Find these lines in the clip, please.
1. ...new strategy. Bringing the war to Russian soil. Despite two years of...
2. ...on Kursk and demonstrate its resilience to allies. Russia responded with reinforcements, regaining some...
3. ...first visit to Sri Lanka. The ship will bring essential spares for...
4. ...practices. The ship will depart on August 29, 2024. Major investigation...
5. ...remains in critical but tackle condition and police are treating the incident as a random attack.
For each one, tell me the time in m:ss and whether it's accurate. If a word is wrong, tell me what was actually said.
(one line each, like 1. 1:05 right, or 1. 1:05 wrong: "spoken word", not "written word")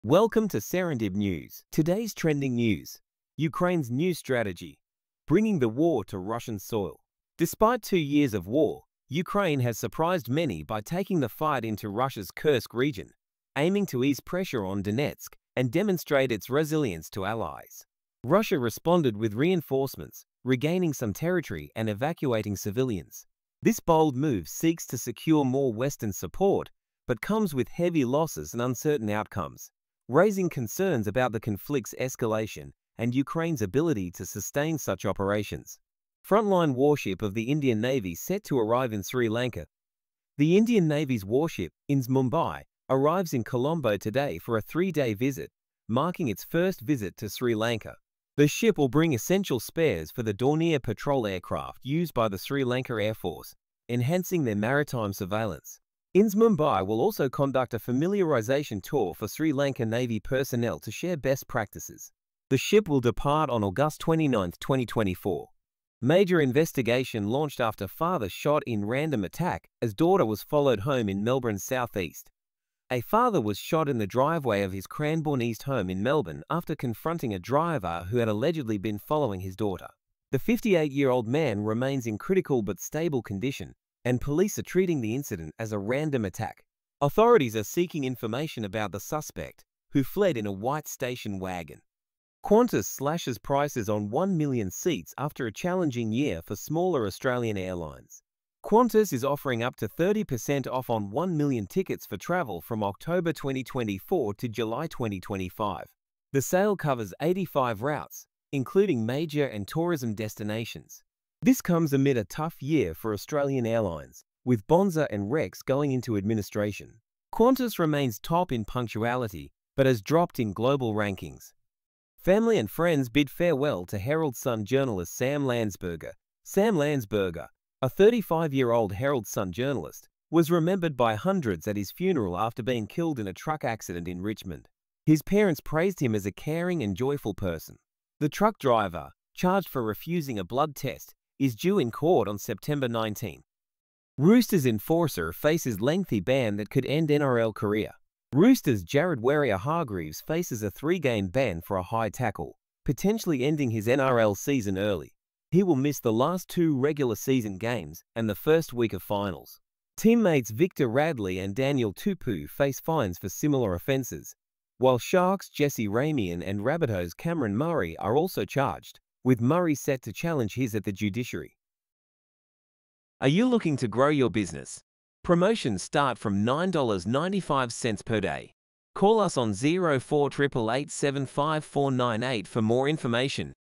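1. 0:03 right
2. 0:14 wrong: "Donetsk", not "Kursk"
3. 0:46 right
4. 1:01 right
5. 1:21 wrong: "stable", not "tackle".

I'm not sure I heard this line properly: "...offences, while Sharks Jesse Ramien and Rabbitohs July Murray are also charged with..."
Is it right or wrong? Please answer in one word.
wrong.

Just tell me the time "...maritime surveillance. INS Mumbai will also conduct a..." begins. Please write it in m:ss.
0:54.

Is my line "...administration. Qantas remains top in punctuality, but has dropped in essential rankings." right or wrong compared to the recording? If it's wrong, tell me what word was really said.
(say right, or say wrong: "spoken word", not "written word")
wrong: "global", not "essential".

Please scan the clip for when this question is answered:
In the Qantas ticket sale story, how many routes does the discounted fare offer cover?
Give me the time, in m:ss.
1:47.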